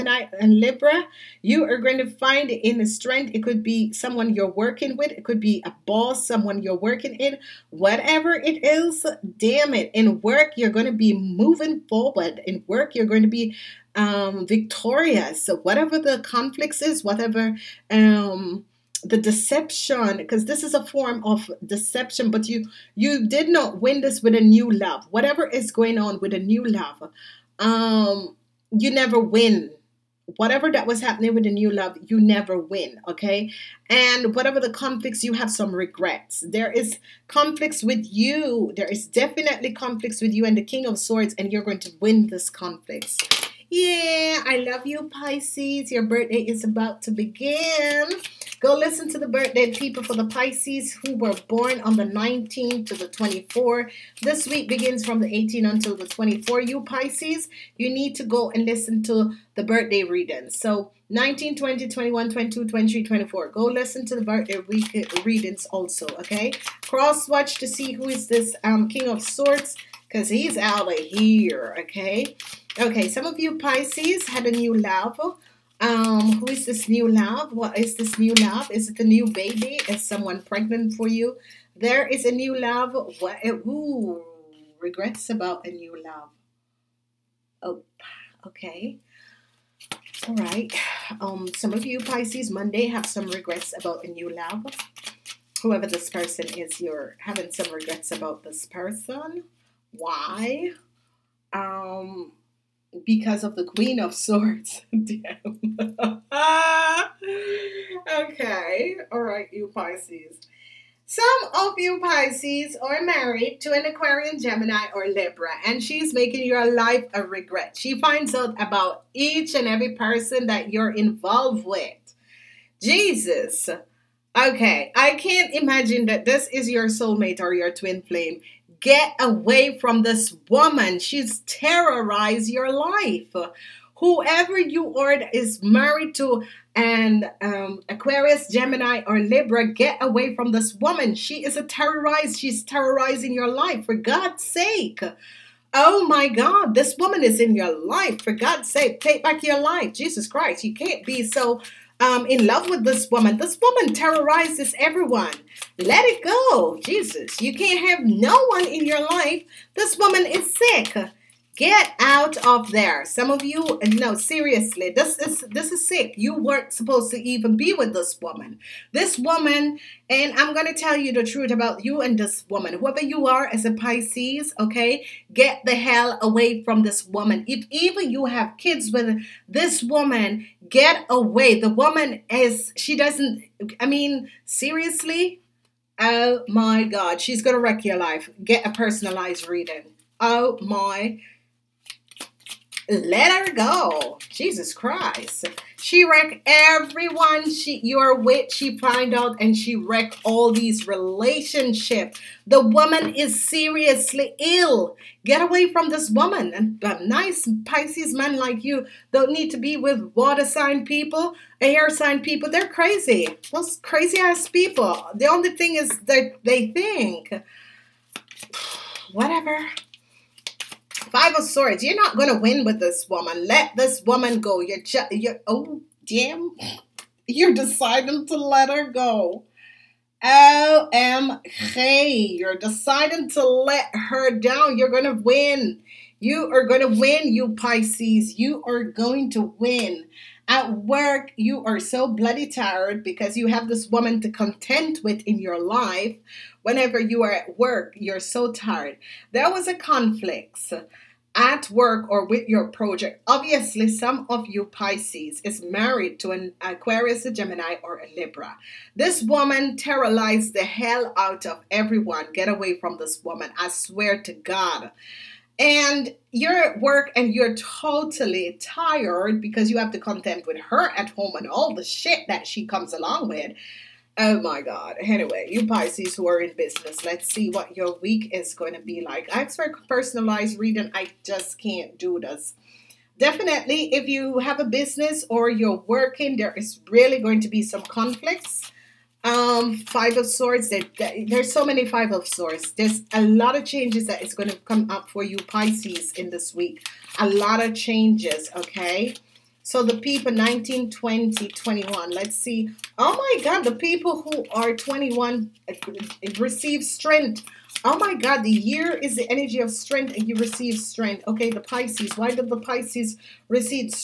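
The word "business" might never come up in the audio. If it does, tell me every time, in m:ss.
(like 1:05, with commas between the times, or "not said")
4:36, 4:44.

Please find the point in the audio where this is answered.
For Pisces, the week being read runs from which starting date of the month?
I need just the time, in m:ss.
0:55.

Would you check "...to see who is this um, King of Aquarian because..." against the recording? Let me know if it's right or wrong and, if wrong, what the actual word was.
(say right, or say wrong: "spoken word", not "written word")
wrong: "Swords", not "Aquarian".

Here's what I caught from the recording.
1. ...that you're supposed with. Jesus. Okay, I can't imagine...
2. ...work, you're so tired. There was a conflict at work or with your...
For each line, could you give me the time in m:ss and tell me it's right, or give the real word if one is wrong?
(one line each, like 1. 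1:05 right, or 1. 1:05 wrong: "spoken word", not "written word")
1. 2:00 wrong: "involved", not "supposed"
2. 4:07 right.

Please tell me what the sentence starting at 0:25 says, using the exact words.
Whatever is going on with a new love, um, you never win.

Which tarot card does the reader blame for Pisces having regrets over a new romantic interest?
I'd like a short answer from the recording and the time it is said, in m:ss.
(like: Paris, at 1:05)
Queen of Swords, at 1:43.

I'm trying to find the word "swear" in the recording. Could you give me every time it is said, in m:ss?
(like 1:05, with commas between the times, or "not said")
4:23.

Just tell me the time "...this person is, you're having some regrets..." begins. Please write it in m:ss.
1:35.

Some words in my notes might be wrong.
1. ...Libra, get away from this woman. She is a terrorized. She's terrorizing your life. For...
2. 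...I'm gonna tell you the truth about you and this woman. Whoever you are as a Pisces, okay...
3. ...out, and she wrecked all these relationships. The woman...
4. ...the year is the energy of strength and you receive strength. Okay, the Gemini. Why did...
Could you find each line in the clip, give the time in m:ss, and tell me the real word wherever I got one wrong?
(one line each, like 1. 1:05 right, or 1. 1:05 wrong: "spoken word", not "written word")
1. 2:19 right
2. 2:50 right
3. 3:19 right
4. 5:08 wrong: "Pisces", not "Gemini".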